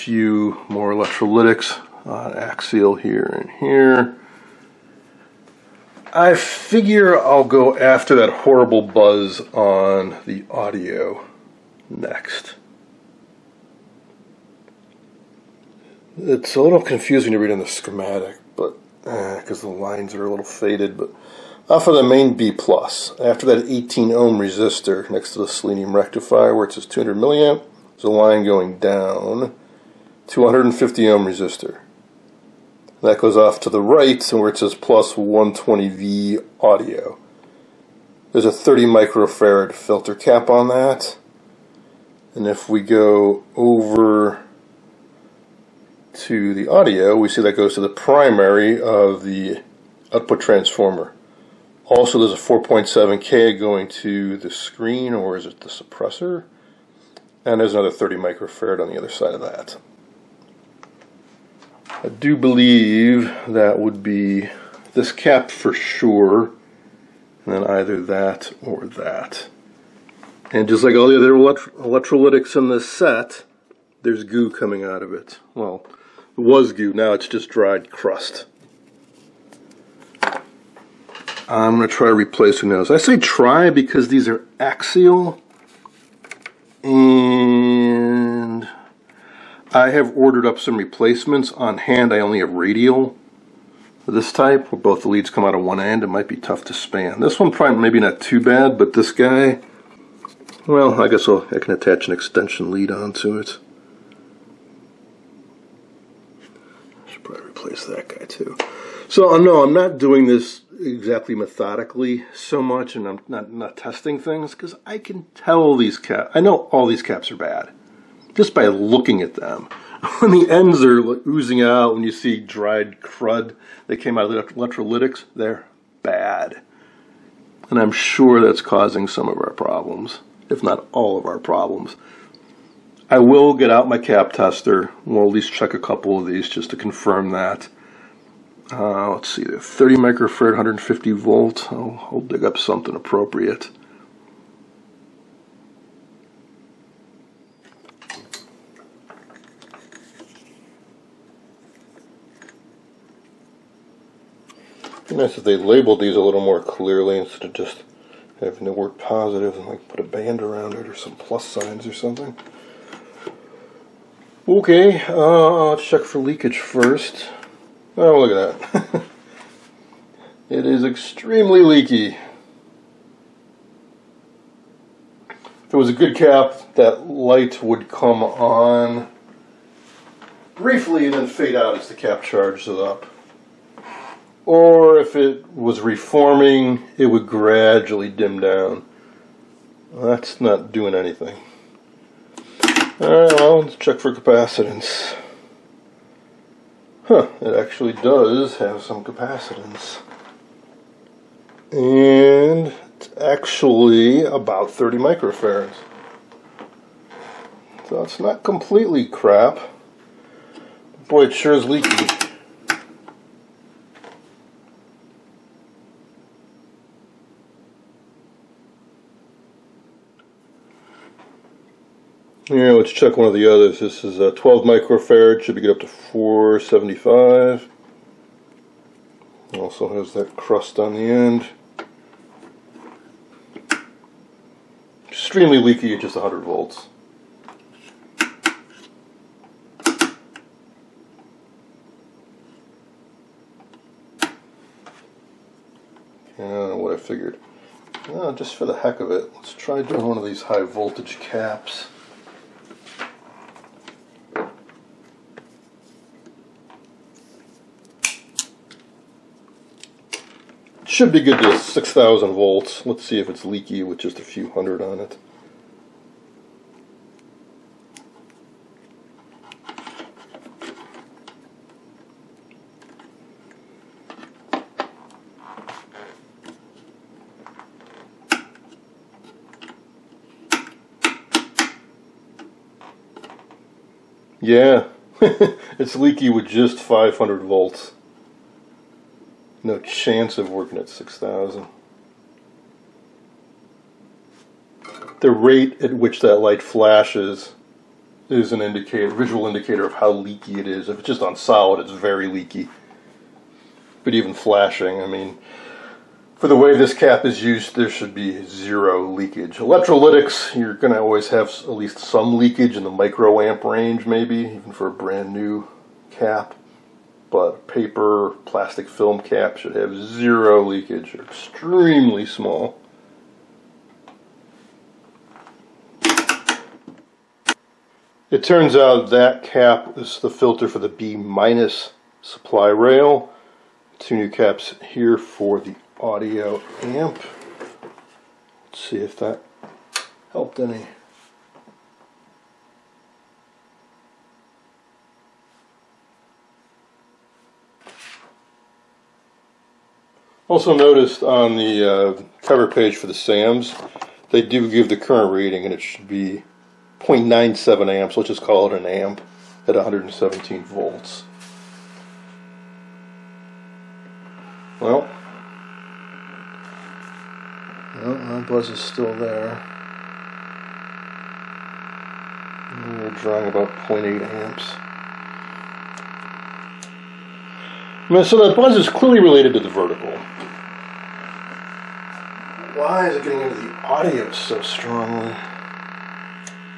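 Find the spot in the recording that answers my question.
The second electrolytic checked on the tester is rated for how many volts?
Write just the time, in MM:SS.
03:45.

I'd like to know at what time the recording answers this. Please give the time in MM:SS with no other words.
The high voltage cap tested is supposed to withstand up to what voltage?
04:21.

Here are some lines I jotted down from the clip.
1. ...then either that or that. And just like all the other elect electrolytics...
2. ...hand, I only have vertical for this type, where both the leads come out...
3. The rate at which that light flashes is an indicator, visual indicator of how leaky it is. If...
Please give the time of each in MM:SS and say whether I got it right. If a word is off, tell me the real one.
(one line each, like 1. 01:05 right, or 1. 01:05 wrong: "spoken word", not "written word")
1. 01:07 right
2. 01:31 wrong: "radial", not "vertical"
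3. 04:55 right.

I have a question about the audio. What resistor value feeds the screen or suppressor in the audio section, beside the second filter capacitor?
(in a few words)
4.7K.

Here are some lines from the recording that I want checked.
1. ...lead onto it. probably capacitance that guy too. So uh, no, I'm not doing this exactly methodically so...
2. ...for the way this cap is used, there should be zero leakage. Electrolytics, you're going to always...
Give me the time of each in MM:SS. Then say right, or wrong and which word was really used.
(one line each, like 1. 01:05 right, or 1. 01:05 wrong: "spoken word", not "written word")
1. 01:42 wrong: "replace", not "capacitance"
2. 05:06 right.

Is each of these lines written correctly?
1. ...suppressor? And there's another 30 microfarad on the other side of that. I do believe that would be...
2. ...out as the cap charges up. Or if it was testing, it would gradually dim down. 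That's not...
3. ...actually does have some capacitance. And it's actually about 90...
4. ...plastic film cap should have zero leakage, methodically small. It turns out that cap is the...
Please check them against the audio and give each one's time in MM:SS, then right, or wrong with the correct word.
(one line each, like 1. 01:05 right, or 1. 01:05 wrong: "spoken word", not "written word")
1. 00:55 right
2. 03:01 wrong: "reforming", not "testing"
3. 03:17 wrong: "30", not "90"
4. 05:18 wrong: "extremely", not "methodically".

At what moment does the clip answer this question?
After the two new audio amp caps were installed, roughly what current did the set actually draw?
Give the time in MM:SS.
06:13.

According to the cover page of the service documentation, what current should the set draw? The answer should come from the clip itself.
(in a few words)
0.97 amps.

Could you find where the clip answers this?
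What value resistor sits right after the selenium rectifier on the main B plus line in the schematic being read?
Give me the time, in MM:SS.
00:23.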